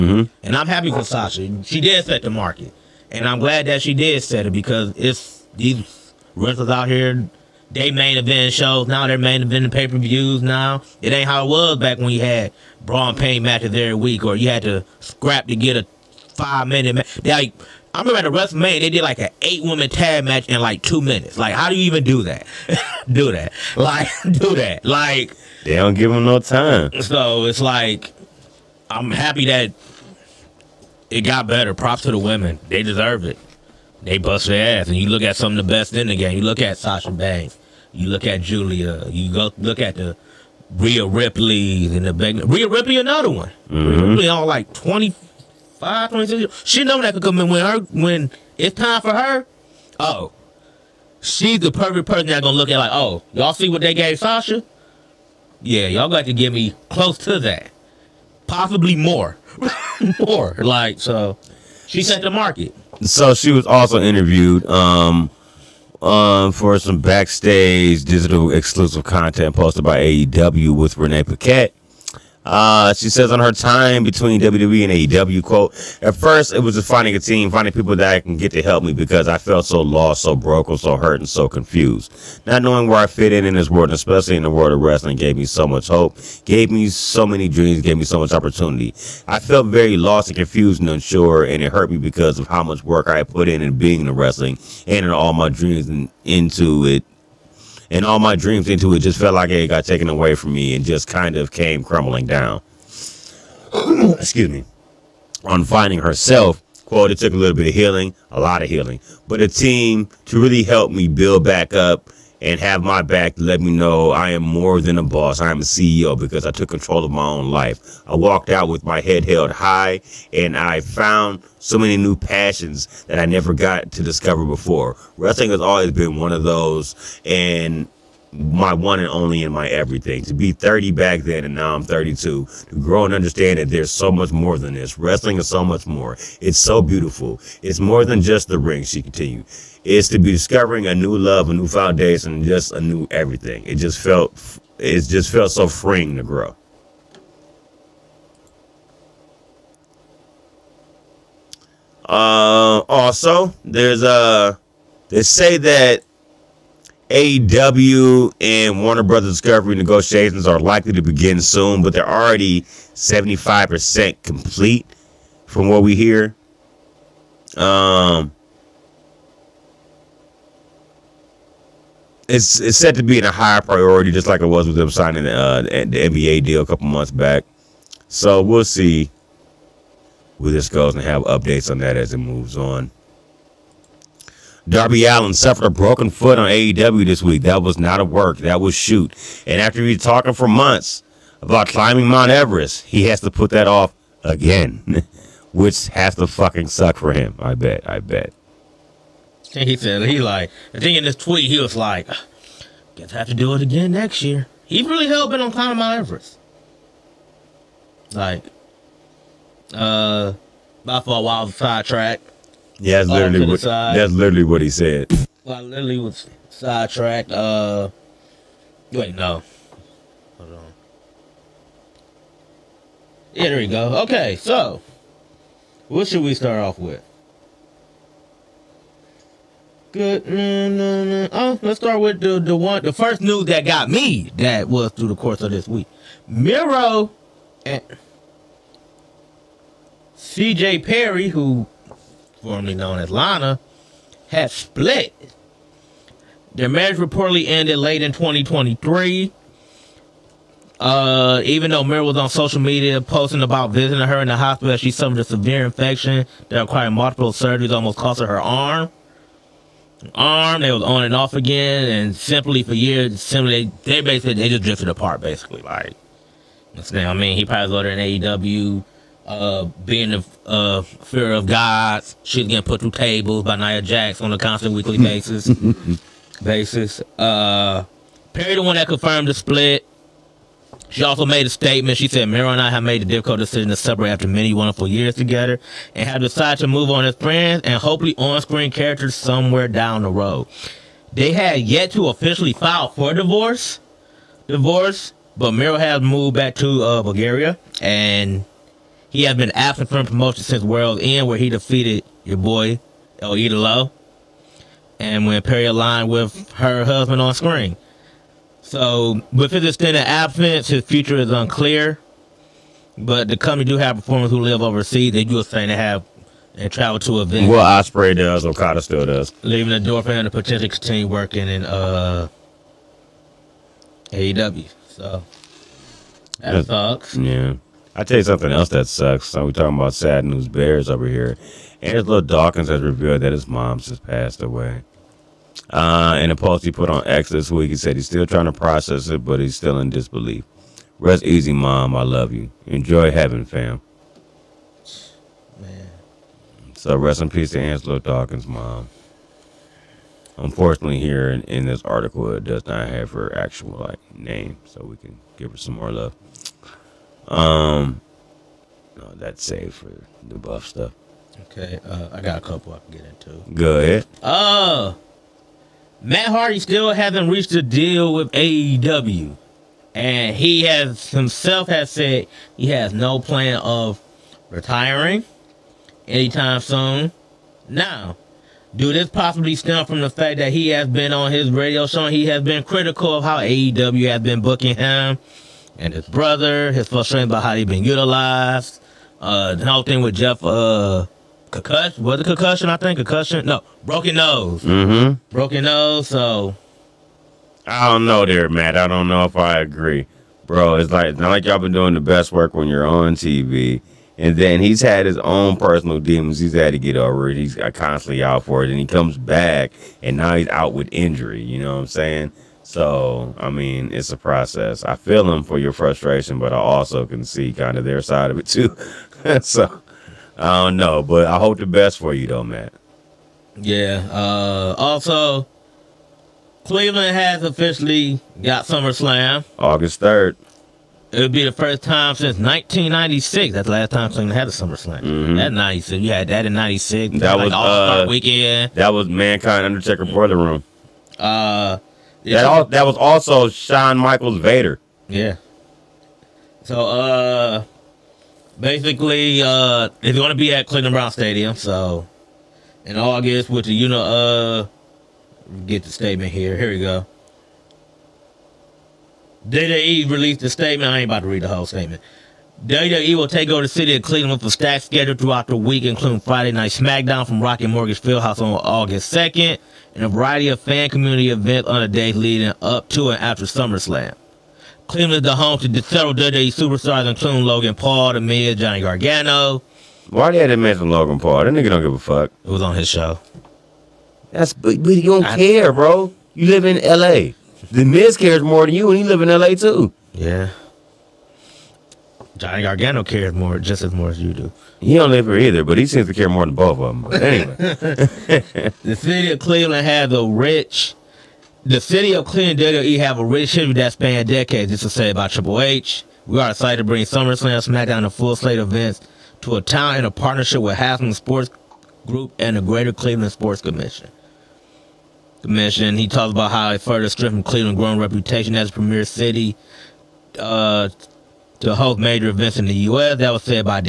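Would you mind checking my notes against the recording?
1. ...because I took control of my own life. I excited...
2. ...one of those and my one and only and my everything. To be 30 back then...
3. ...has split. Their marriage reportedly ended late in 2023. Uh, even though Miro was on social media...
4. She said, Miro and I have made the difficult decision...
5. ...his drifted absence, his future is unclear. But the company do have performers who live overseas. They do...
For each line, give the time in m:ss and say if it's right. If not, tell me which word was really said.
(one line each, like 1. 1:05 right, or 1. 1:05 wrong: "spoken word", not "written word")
1. 1:56 wrong: "walked", not "excited"
2. 2:06 right
3. 4:04 right
4. 4:41 right
5. 5:09 wrong: "extended", not "drifted".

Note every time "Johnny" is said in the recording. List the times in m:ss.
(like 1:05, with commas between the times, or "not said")
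7:58, 8:12.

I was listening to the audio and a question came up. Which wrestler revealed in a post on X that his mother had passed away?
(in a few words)
Angelo Dawkins.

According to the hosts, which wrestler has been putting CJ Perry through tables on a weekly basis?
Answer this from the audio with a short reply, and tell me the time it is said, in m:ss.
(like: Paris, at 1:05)
Nia Jax, at 4:33.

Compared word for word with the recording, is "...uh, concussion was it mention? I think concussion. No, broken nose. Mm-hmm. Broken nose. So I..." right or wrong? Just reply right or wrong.
wrong.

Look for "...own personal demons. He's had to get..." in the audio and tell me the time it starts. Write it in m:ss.
6:45.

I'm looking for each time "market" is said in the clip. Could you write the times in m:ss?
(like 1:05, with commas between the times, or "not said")
0:02, 1:02.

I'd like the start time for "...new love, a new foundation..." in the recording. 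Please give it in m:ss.
2:20.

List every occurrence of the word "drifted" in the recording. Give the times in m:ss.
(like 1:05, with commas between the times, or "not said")
4:24.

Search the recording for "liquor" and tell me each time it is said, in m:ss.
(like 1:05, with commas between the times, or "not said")
not said.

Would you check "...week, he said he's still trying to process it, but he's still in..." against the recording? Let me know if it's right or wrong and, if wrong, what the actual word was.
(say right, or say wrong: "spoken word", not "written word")
right.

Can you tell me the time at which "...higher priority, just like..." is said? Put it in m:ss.
2:53.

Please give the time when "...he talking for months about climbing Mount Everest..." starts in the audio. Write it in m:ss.
3:09.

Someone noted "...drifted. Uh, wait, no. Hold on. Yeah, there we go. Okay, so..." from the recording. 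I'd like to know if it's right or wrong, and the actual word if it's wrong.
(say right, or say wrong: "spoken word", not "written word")
wrong: "sidetracked", not "drifted".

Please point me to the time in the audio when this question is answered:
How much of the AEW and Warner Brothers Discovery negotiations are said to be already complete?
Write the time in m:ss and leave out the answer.
2:42.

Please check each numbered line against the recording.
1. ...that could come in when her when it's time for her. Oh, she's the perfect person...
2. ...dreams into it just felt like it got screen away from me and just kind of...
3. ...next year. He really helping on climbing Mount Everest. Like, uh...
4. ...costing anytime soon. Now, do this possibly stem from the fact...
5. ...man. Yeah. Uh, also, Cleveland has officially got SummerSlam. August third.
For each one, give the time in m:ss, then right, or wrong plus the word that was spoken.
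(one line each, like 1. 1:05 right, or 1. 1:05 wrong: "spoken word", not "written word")
1. 0:47 right
2. 1:38 wrong: "taken", not "screen"
3. 3:23 right
4. 6:14 wrong: "retiring", not "costing"
5. 7:02 right.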